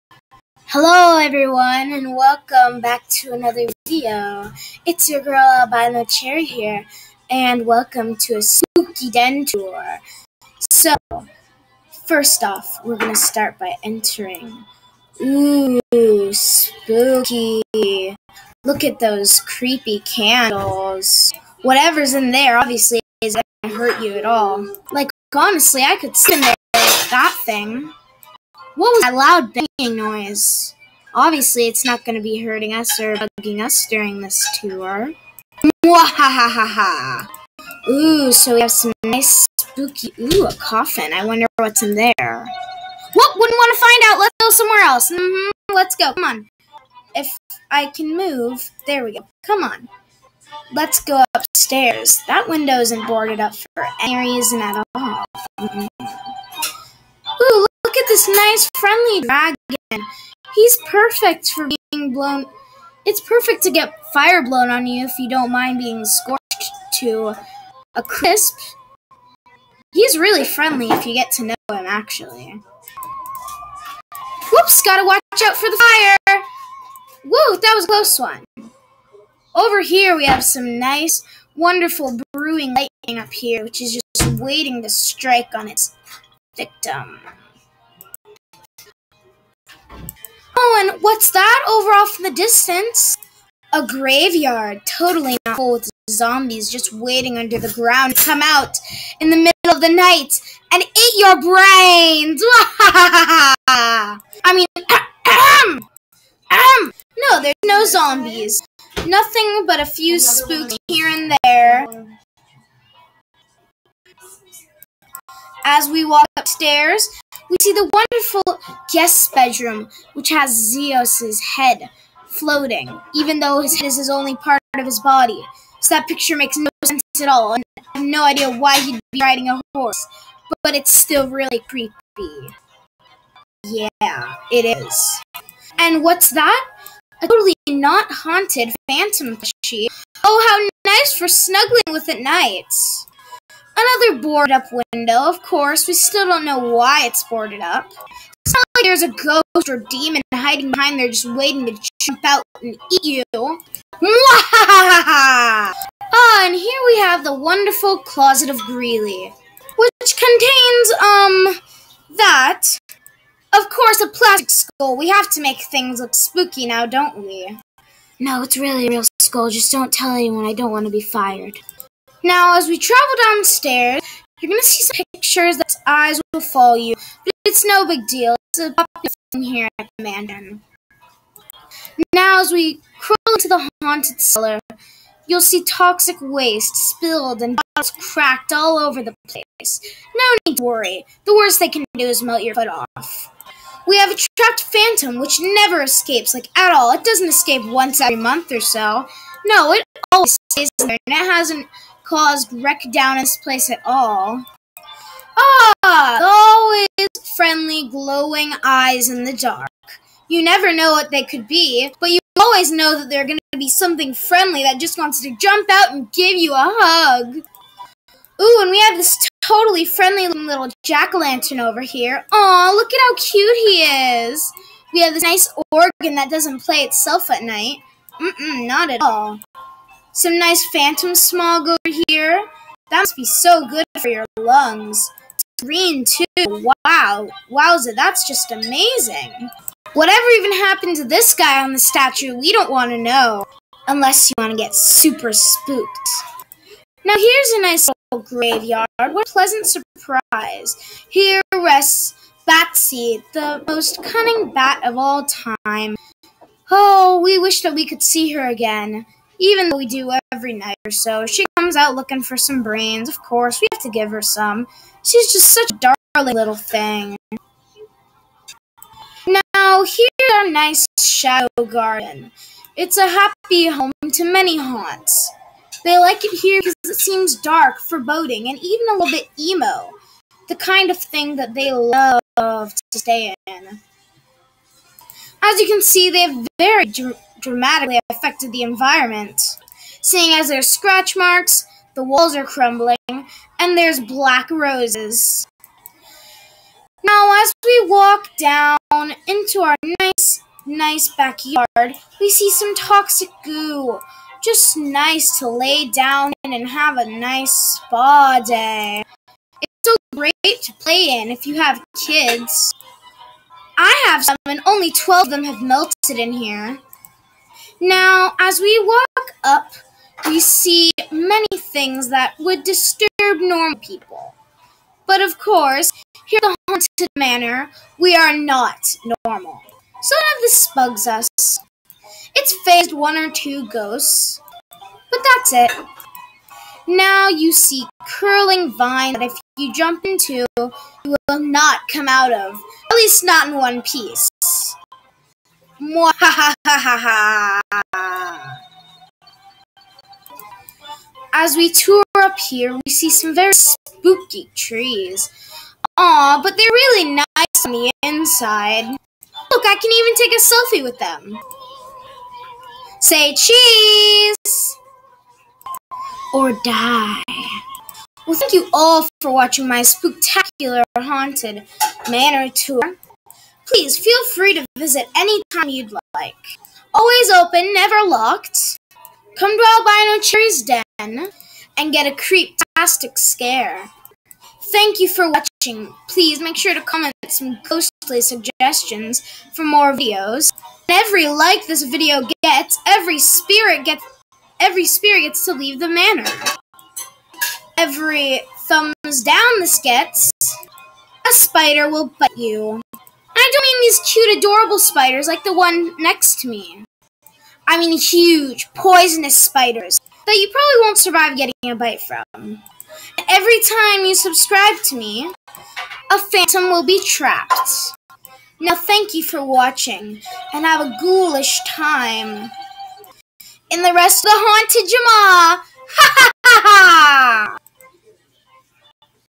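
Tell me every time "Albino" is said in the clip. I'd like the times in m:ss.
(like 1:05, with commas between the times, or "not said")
0:05, 6:19.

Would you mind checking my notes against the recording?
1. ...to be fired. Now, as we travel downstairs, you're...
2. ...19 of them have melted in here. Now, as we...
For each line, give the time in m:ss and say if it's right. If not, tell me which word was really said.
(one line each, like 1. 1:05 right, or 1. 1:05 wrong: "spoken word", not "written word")
1. 2:50 right
2. 5:14 wrong: "12", not "19".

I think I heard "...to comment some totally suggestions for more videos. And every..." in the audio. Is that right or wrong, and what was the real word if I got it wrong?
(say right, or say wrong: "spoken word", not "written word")
wrong: "ghostly", not "totally".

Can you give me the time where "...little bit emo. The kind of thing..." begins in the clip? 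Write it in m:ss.
4:38.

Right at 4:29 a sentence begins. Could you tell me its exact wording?
Now, here's our nice shadow garden.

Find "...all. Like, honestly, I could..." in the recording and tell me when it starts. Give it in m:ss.
0:24.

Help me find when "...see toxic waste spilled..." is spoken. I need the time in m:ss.
3:05.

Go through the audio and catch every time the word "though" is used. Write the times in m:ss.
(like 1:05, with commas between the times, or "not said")
2:03, 4:19.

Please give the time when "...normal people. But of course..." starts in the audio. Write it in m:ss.
5:23.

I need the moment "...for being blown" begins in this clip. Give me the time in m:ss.
1:01.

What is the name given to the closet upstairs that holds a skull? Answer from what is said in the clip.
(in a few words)
closet of Greeley.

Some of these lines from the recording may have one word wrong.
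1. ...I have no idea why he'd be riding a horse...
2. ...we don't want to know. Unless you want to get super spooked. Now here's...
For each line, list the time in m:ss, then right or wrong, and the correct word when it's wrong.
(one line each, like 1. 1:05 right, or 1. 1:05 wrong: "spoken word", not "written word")
1. 2:07 right
2. 4:02 right.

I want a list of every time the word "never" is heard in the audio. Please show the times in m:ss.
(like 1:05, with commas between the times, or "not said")
3:15, 3:30, 6:17.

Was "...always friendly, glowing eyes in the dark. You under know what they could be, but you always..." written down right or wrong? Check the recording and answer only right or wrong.
wrong.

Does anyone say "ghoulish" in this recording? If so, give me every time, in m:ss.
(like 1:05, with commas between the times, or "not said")
7:01.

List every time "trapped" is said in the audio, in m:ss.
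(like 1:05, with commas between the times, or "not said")
3:14, 6:57.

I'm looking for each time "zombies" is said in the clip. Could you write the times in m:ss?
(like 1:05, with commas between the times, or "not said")
1:36, 1:47.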